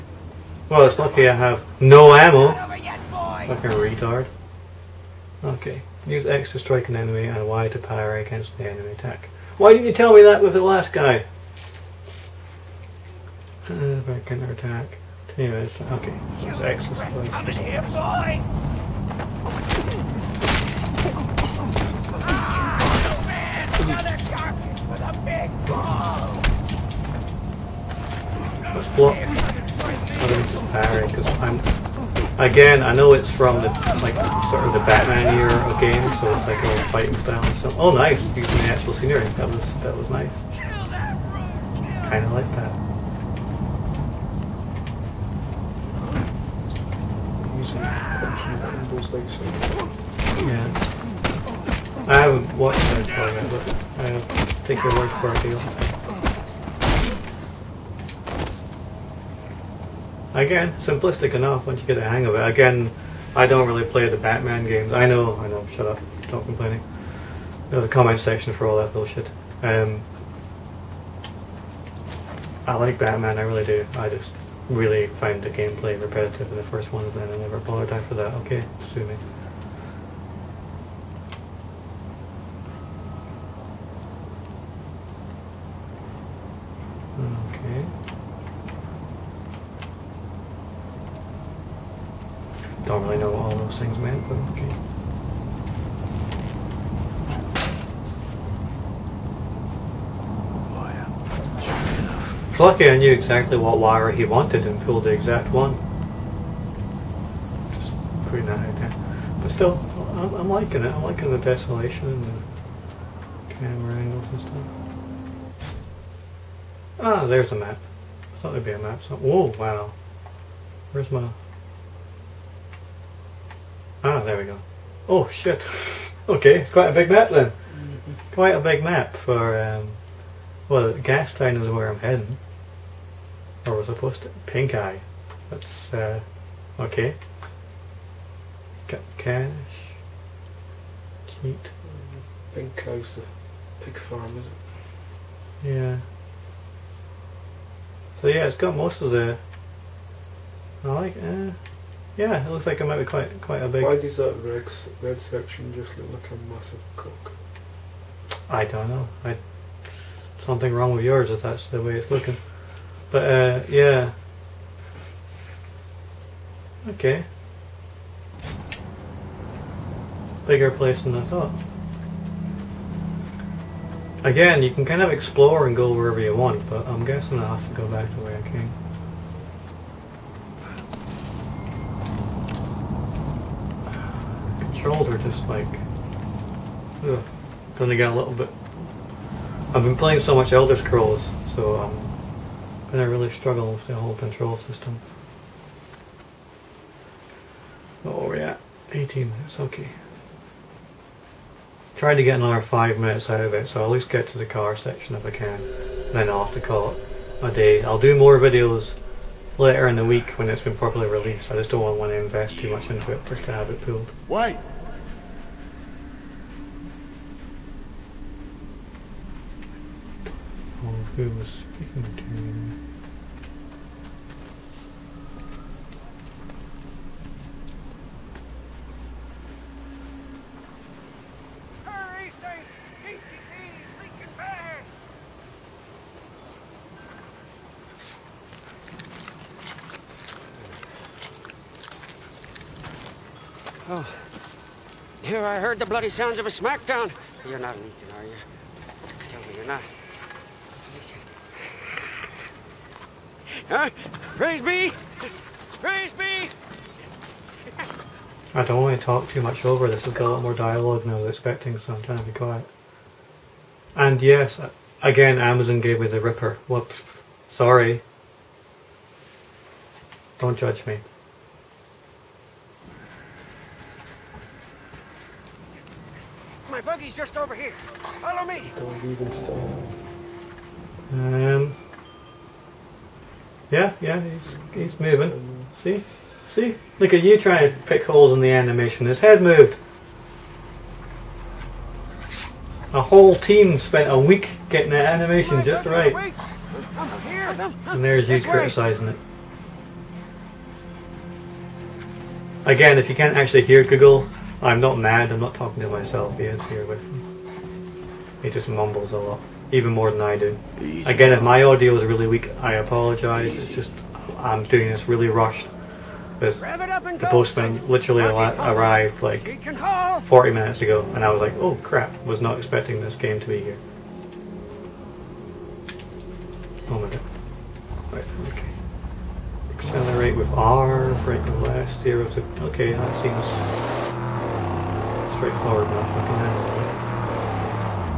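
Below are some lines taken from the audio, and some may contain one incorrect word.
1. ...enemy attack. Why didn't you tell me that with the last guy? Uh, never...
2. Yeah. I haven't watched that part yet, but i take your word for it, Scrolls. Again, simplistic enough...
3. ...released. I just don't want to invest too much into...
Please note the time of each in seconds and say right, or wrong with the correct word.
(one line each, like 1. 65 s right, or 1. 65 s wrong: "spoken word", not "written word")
1. 8 s wrong: "counter", not "never"
2. 50 s wrong: "Deal", not "Scrolls"
3. 211 s right.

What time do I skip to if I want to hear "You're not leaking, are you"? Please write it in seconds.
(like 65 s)
247 s.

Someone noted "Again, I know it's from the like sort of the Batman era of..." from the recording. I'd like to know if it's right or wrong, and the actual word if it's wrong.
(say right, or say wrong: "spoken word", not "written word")
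right.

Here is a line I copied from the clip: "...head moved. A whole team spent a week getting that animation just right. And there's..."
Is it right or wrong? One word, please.
right.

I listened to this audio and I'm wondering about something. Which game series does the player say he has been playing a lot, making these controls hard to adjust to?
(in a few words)
Elder Scrolls.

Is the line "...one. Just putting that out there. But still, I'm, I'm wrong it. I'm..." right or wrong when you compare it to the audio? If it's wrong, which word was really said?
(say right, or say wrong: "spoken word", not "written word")
wrong: "liking", not "wrong".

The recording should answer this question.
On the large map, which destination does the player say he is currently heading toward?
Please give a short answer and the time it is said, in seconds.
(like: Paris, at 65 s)
Gastown, at 130 s.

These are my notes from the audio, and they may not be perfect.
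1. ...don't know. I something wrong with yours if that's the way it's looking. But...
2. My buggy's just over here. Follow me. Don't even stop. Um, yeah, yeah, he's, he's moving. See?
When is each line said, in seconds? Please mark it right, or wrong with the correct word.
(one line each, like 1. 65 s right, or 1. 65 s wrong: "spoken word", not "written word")
1. 158 s right
2. 276 s right.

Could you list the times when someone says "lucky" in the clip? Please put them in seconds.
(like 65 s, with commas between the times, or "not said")
0 s, 102 s.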